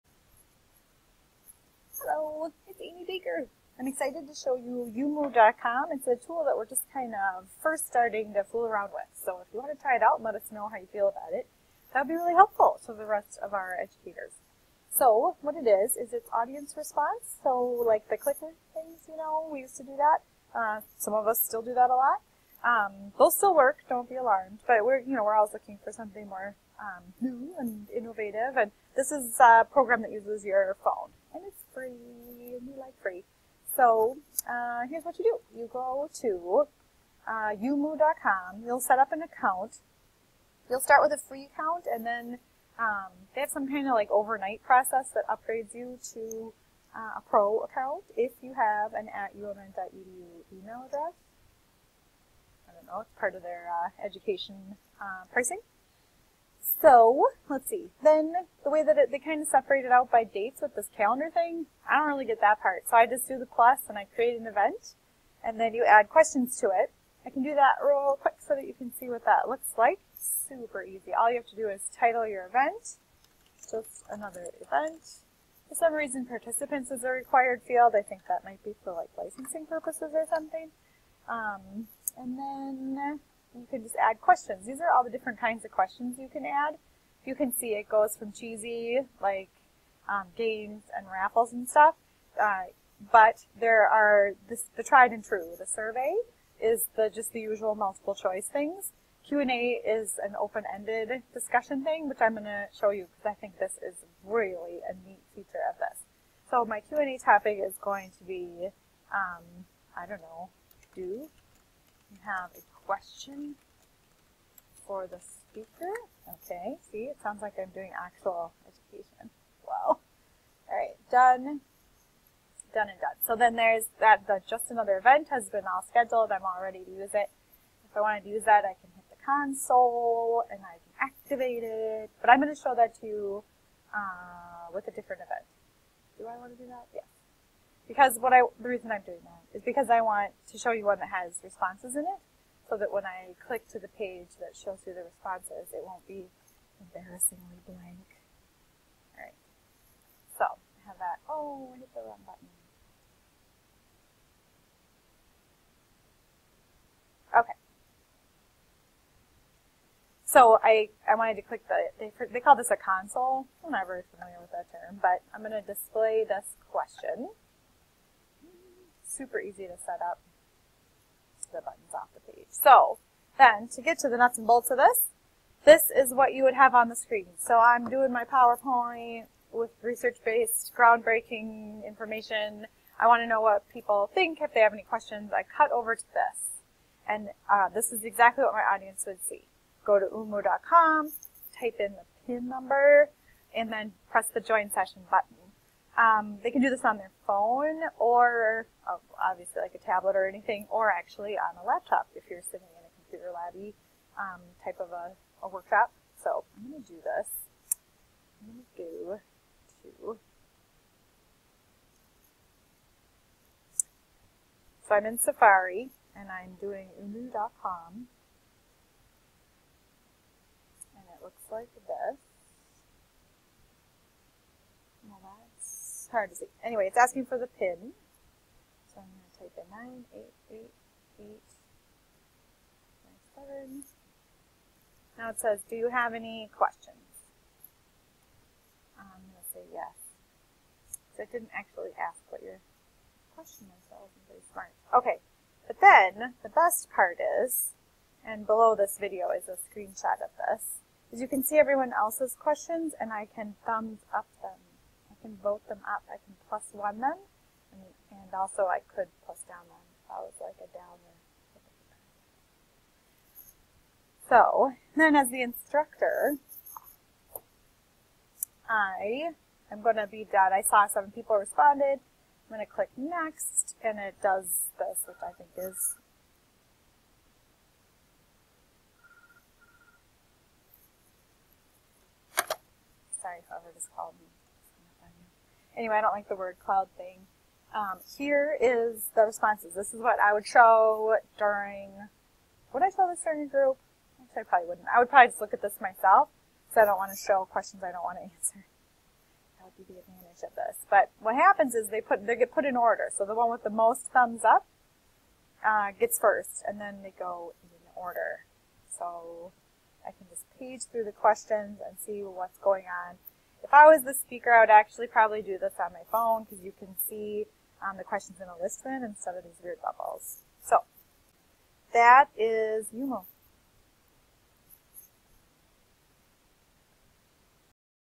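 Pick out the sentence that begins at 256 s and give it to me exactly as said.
I can plus one them, and, and also I could plus down them if I was like a downer.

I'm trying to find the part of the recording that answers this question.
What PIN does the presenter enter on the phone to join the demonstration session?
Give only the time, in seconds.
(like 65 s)
229 s.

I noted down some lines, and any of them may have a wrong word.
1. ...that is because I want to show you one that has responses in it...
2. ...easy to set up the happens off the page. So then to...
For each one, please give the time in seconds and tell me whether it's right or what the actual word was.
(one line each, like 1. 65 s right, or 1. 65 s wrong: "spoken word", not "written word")
1. 139 s right
2. 169 s wrong: "buttons", not "happens".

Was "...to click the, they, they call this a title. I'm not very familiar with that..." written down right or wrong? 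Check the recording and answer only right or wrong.
wrong.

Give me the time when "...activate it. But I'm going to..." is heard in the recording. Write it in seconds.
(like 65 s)
130 s.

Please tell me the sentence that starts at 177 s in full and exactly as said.
So I'm doing my PowerPoint with research-based, groundbreaking information.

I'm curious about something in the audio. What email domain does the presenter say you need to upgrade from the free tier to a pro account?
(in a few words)
umn.edu.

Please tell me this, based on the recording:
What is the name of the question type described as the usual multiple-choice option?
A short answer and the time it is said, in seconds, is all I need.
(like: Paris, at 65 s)
survey, at 95 s.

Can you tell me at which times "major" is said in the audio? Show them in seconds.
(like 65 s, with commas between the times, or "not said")
not said.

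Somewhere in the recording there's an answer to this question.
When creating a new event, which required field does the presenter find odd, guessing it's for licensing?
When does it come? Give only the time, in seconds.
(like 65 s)
76 s.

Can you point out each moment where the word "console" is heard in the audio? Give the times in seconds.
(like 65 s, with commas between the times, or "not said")
129 s, 162 s.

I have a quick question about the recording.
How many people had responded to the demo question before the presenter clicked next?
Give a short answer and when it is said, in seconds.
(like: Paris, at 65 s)
7, at 270 s.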